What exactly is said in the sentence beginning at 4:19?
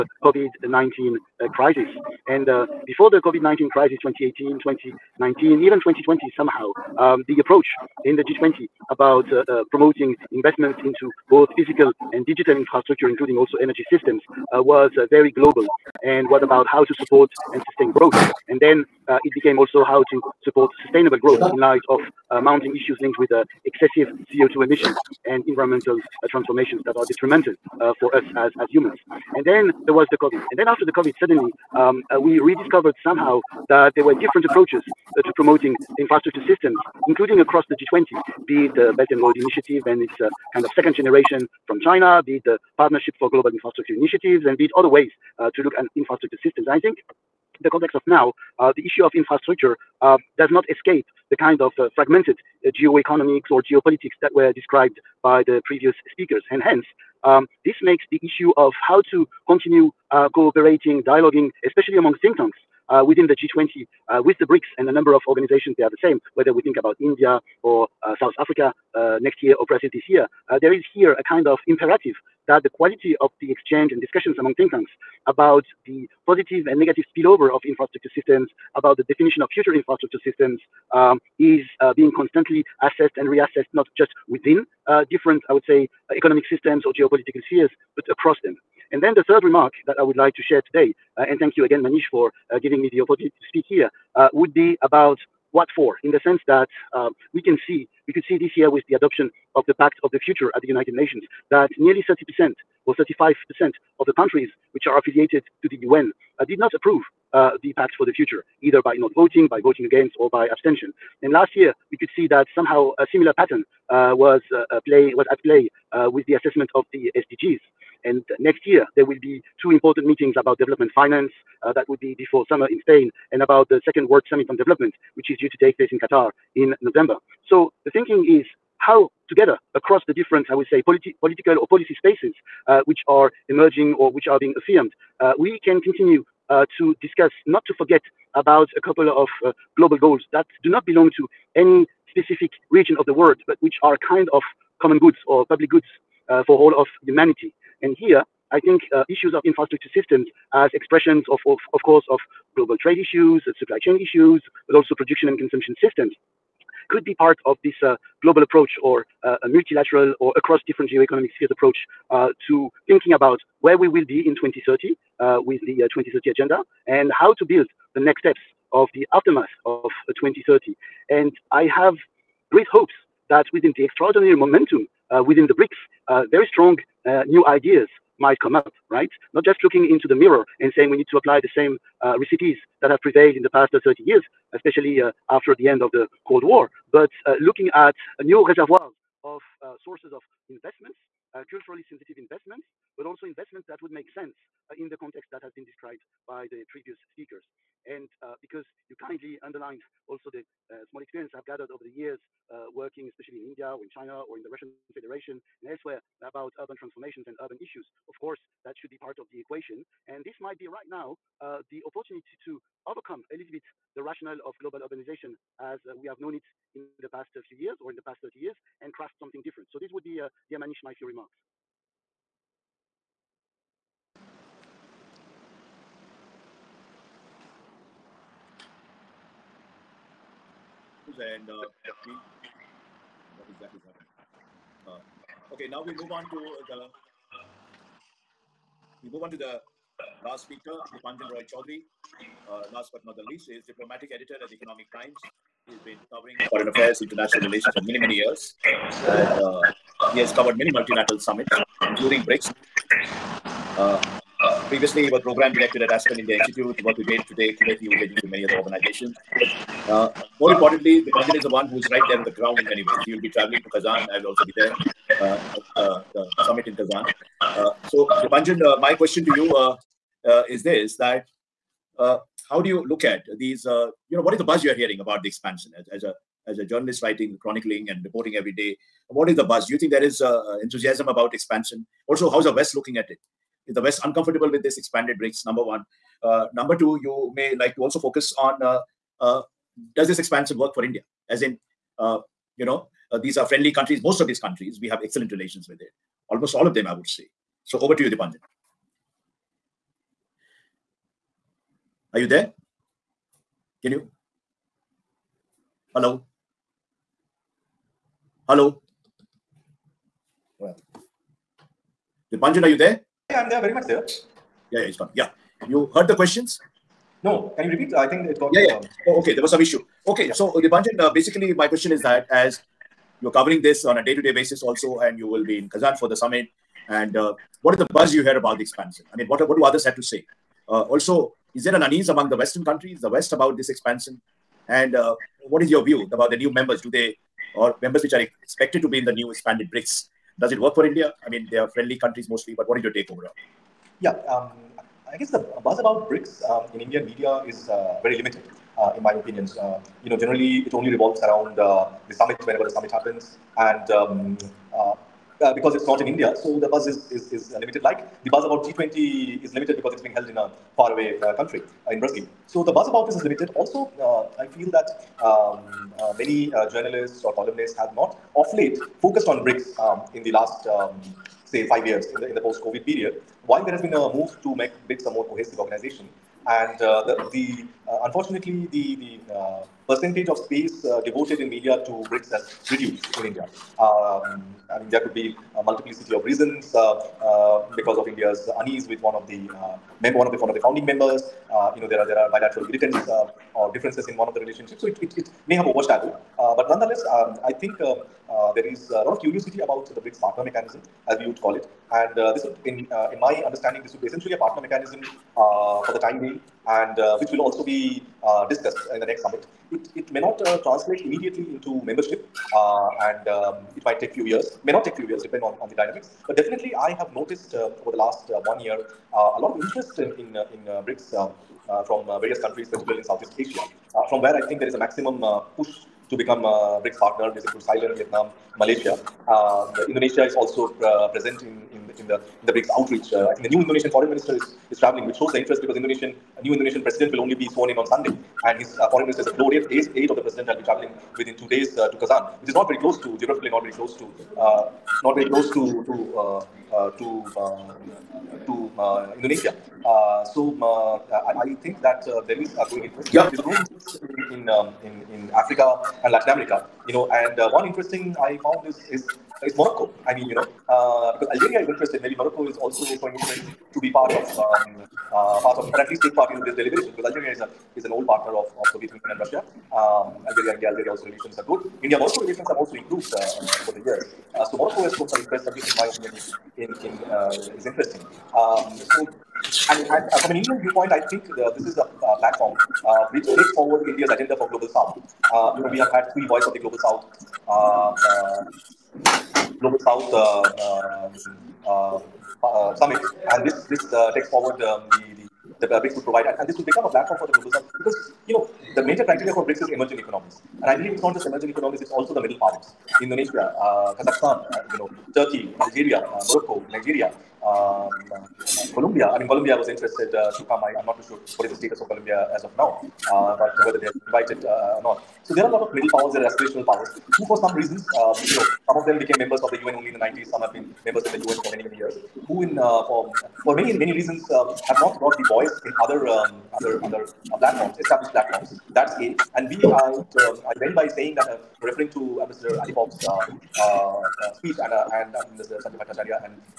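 Uh, more importantly, the president is the one who is right there on the ground in many ways.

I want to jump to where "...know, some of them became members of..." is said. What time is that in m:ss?
8:38.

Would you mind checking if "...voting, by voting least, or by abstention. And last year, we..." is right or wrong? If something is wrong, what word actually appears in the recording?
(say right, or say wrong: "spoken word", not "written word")
wrong: "against", not "least".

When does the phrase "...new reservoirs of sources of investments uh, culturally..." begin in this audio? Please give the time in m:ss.
3:08.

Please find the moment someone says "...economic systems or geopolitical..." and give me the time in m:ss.
1:26.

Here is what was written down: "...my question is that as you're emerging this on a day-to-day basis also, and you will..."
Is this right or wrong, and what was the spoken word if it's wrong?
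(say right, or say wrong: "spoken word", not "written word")
wrong: "covering", not "emerging".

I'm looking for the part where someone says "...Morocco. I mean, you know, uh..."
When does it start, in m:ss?
7:39.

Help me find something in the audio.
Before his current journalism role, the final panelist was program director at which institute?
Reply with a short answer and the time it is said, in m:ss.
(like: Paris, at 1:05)
Aspen India Institute, at 4:15.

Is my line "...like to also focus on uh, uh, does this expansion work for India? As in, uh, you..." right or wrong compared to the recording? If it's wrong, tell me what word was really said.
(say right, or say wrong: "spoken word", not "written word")
right.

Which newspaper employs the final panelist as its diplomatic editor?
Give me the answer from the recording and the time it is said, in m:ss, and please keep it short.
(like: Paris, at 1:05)
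Economic Times, at 4:04.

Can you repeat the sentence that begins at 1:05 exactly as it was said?
They are the same, whether we think about India or uh, South Africa uh, next year or Brazil this year.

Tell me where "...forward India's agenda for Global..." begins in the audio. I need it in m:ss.
8:03.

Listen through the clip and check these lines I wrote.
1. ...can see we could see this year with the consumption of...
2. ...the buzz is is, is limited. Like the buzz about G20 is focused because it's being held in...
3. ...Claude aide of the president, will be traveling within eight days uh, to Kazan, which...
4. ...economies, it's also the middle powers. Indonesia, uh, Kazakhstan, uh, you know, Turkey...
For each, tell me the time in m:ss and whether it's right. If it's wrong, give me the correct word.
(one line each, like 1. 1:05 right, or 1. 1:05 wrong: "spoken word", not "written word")
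1. 1:37 wrong: "adoption", not "consumption"
2. 5:56 wrong: "limited", not "focused"
3. 7:19 wrong: "two", not "eight"
4. 8:21 right.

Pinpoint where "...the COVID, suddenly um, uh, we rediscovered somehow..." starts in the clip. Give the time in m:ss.
0:30.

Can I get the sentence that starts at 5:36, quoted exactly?
Do they, or members which are expected to be in the new expanded BRICS?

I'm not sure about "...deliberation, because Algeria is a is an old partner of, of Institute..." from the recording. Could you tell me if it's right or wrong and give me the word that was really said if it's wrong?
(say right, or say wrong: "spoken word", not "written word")
wrong: "Soviet", not "Institute".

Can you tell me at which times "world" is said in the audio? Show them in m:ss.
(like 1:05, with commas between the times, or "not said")
2:04, 2:23.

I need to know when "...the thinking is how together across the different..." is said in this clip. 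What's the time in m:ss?
2:07.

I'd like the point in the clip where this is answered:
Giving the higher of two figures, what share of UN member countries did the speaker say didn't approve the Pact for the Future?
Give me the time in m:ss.
1:42.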